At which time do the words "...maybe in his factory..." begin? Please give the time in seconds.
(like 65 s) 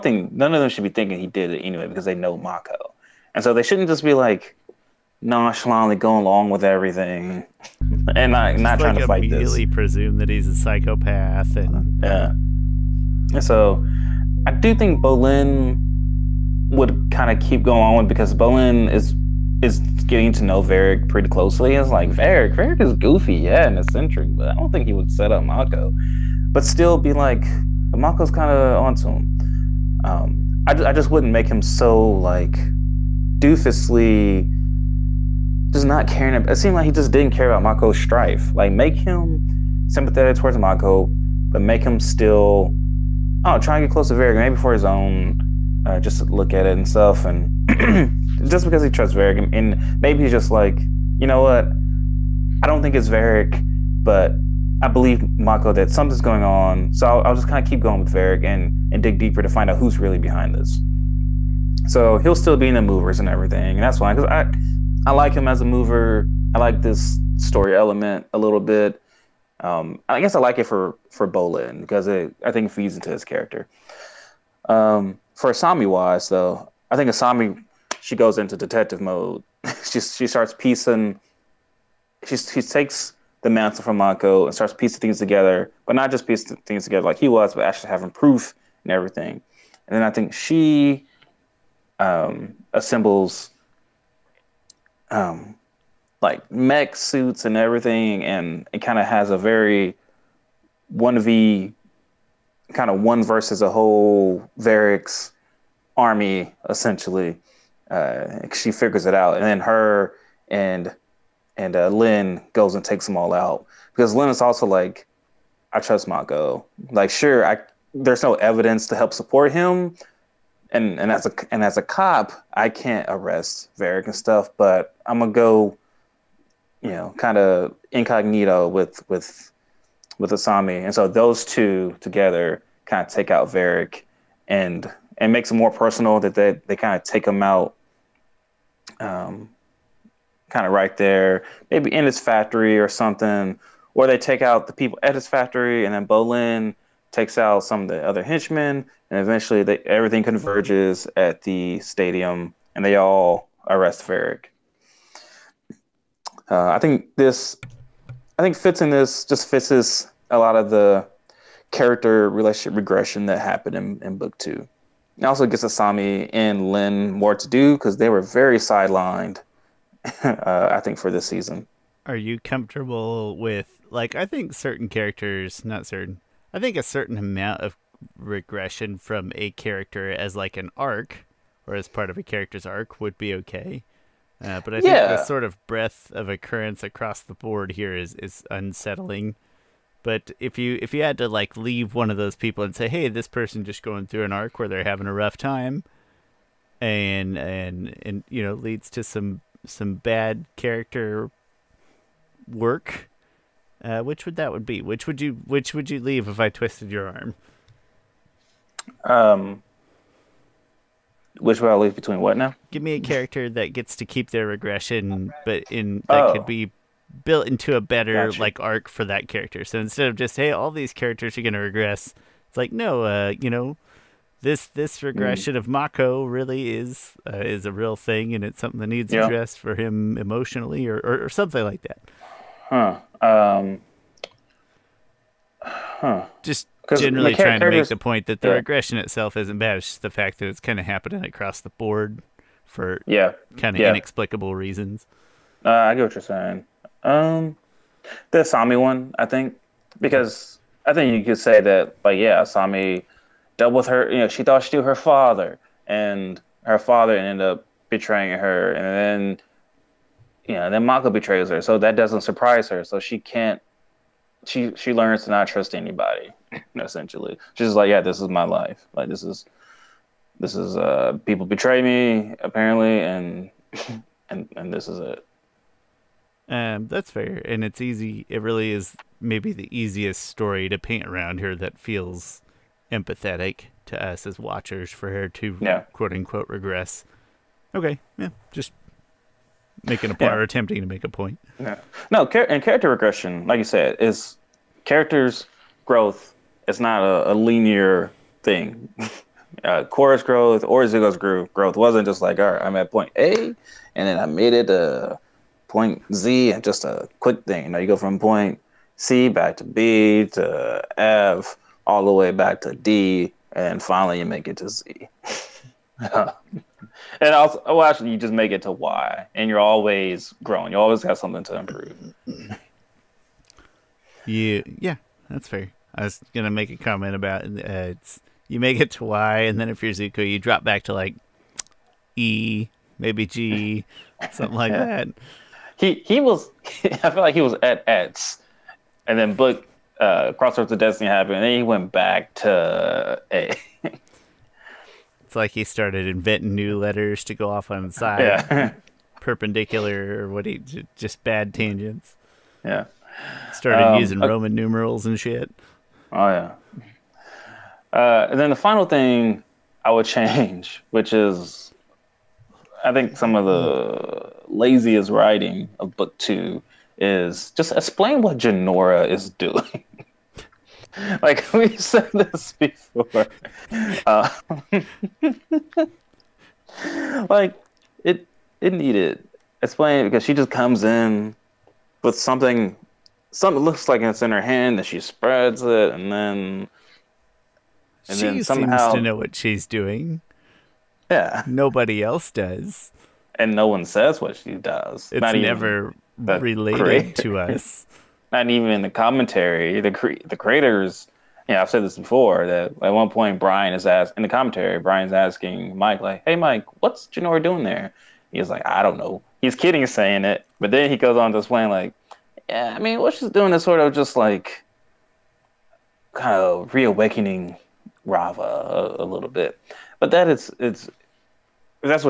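141 s.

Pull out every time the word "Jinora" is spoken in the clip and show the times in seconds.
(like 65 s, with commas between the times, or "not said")
368 s, 407 s.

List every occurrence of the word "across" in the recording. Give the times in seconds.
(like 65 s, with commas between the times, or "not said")
186 s, 241 s.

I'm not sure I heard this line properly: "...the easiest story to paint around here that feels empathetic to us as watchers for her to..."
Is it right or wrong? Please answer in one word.
right.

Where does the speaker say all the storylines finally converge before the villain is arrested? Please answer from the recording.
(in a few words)
The stadium.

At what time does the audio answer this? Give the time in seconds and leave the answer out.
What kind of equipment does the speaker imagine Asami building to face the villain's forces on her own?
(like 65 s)
96 s.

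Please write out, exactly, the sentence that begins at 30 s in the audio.
Um, I, I just wouldn't make him so like doofusly just not caring.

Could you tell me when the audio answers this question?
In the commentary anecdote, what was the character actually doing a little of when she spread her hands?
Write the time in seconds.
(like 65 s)
416 s.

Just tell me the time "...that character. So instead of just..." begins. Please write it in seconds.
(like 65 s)
219 s.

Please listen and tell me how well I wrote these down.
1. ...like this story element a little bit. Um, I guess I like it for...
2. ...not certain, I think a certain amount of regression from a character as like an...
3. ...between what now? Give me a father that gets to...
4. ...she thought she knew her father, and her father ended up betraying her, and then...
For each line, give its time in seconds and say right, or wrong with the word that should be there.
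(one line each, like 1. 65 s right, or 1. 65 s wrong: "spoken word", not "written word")
1. 66 s right
2. 175 s right
3. 211 s wrong: "character", not "father"
4. 254 s right.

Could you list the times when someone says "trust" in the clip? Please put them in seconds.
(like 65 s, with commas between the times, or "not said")
48 s, 115 s, 265 s.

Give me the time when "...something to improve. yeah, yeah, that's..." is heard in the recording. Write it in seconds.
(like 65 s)
321 s.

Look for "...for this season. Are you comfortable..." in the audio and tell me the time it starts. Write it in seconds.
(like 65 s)
170 s.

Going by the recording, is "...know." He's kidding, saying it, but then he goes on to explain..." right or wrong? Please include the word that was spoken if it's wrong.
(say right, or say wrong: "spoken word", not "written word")
right.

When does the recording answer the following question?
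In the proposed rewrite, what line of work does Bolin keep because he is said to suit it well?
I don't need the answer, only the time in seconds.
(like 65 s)
62 s.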